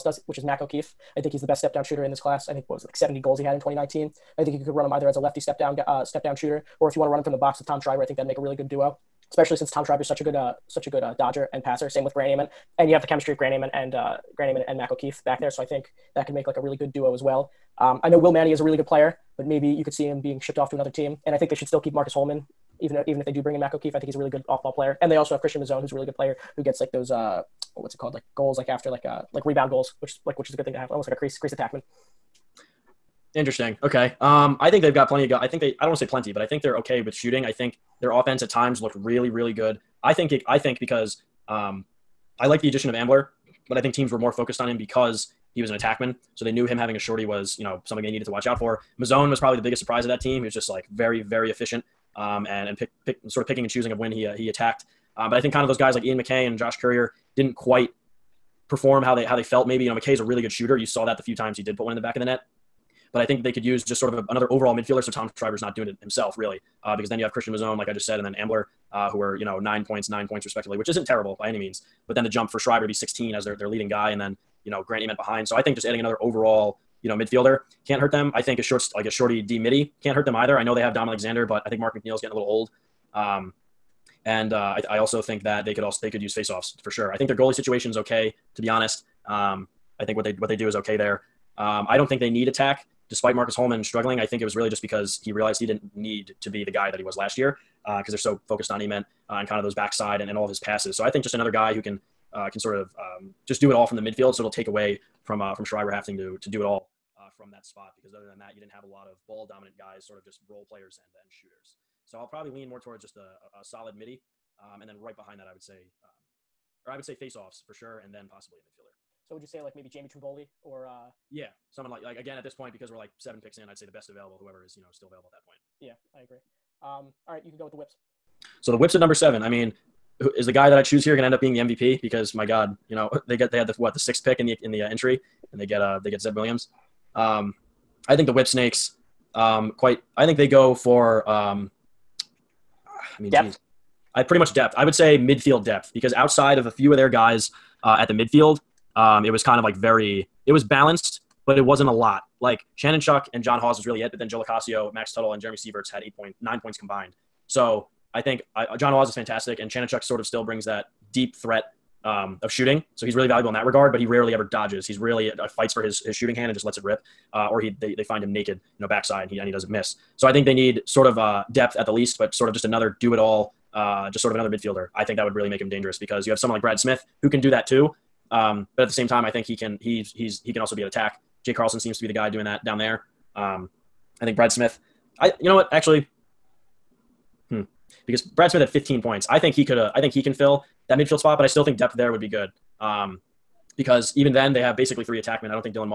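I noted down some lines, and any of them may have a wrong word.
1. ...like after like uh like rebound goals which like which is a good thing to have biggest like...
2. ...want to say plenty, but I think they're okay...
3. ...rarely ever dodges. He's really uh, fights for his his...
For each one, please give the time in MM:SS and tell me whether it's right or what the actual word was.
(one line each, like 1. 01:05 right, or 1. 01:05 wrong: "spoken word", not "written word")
1. 00:28 wrong: "almost", not "biggest"
2. 00:35 right
3. 02:44 right.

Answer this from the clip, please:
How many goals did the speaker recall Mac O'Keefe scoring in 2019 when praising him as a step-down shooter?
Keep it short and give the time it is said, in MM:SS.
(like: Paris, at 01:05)
70, at 00:02.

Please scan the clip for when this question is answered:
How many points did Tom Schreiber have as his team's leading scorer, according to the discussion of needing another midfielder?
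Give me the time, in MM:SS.
01:12.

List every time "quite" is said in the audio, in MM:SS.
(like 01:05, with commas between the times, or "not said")
00:57, 02:19.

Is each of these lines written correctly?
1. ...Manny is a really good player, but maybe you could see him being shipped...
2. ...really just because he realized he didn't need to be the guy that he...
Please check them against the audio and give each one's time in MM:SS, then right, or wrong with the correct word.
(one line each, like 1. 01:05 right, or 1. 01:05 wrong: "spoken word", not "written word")
1. 00:18 right
2. 01:34 right.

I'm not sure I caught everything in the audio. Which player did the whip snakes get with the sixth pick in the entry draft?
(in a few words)
Zed Williams.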